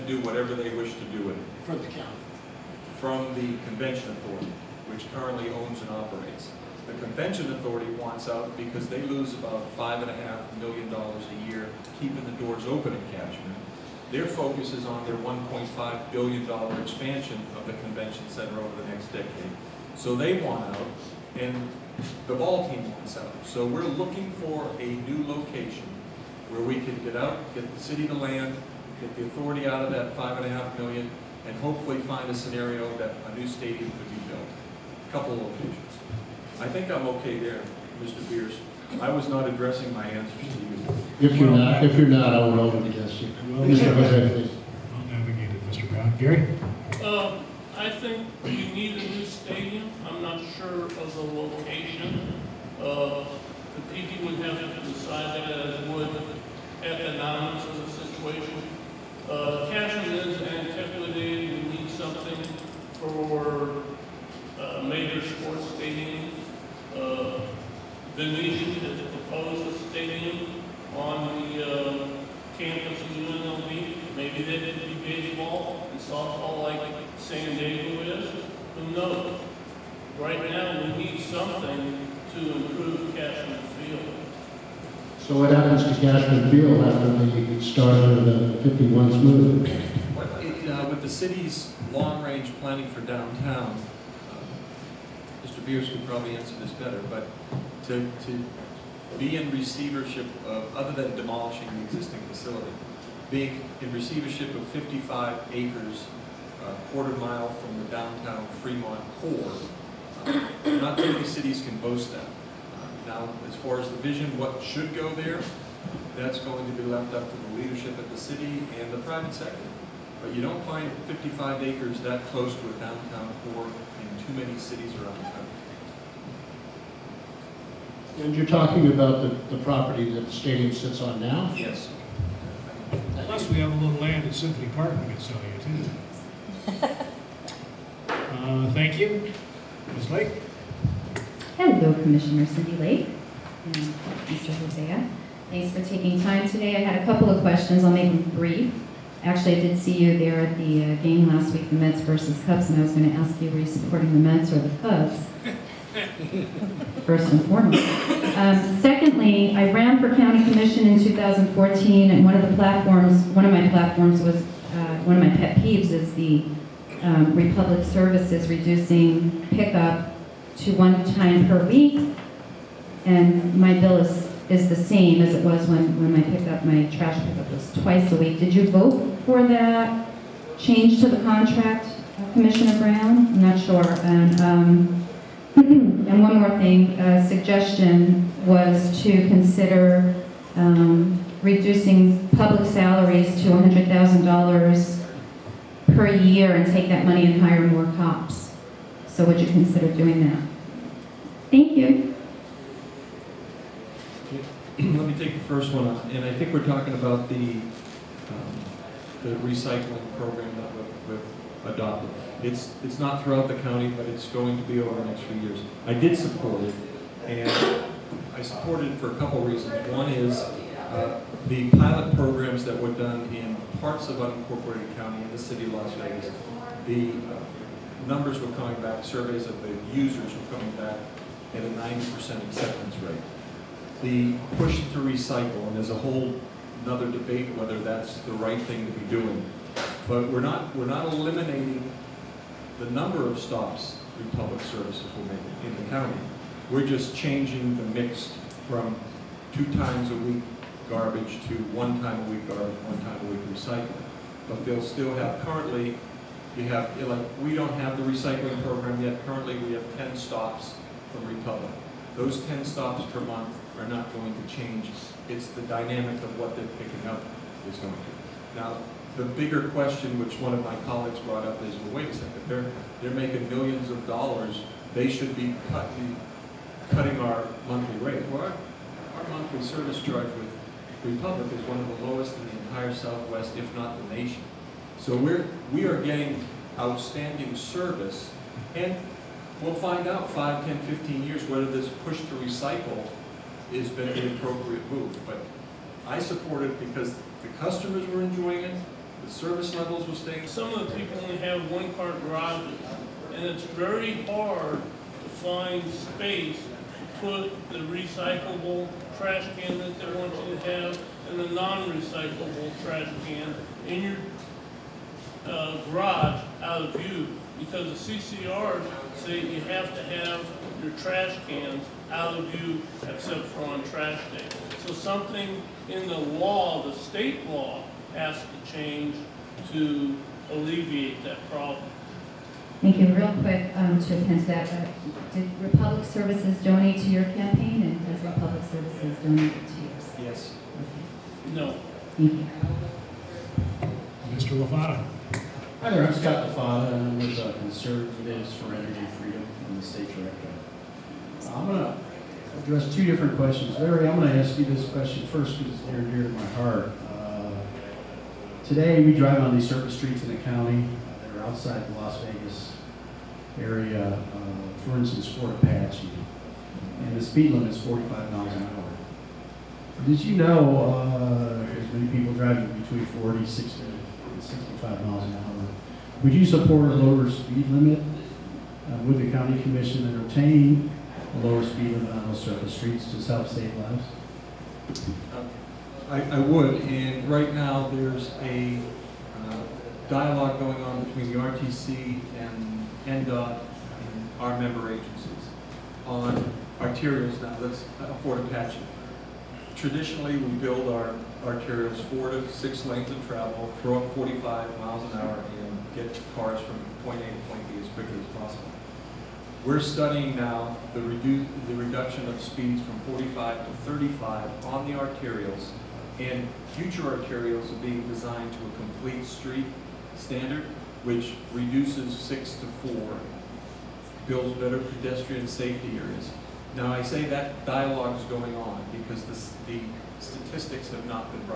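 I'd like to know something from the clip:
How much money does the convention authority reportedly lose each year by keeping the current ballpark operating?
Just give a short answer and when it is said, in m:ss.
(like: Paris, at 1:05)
5.5 million dollars, at 0:09.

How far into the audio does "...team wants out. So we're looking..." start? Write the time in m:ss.
0:22.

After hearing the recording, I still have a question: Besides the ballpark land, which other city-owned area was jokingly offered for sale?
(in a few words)
Symphony Park.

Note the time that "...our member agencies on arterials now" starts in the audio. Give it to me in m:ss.
6:34.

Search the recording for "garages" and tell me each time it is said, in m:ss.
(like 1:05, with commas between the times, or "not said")
5:02, 5:15.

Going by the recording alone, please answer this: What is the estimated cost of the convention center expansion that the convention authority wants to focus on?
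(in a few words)
$1.5 billion.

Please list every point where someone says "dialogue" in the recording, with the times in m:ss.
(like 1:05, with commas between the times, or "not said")
6:30, 7:07.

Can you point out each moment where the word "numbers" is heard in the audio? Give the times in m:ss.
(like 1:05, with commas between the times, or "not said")
3:48, 4:02.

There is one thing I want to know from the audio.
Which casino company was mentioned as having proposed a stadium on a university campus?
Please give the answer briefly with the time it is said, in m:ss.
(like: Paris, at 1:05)
Venetian, at 1:08.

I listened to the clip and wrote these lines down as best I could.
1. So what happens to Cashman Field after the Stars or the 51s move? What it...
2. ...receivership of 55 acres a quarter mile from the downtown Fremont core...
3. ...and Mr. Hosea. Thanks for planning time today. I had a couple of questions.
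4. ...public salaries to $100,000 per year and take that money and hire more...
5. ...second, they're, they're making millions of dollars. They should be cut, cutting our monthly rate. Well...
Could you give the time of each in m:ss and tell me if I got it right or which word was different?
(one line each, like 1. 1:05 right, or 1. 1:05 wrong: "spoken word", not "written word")
1. 1:25 right
2. 1:43 right
3. 2:23 wrong: "taking", not "planning"
4. 3:12 right
5. 4:32 right.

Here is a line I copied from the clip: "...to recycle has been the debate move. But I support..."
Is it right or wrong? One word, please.
wrong.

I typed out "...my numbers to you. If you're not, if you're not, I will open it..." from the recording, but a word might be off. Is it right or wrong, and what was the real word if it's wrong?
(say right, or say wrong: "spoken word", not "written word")
wrong: "answers", not "numbers".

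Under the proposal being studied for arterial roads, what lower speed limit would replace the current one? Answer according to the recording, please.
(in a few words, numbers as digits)
35.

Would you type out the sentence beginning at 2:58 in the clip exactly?
Did you vote for that change to the contract, uh, Commissioner Brown?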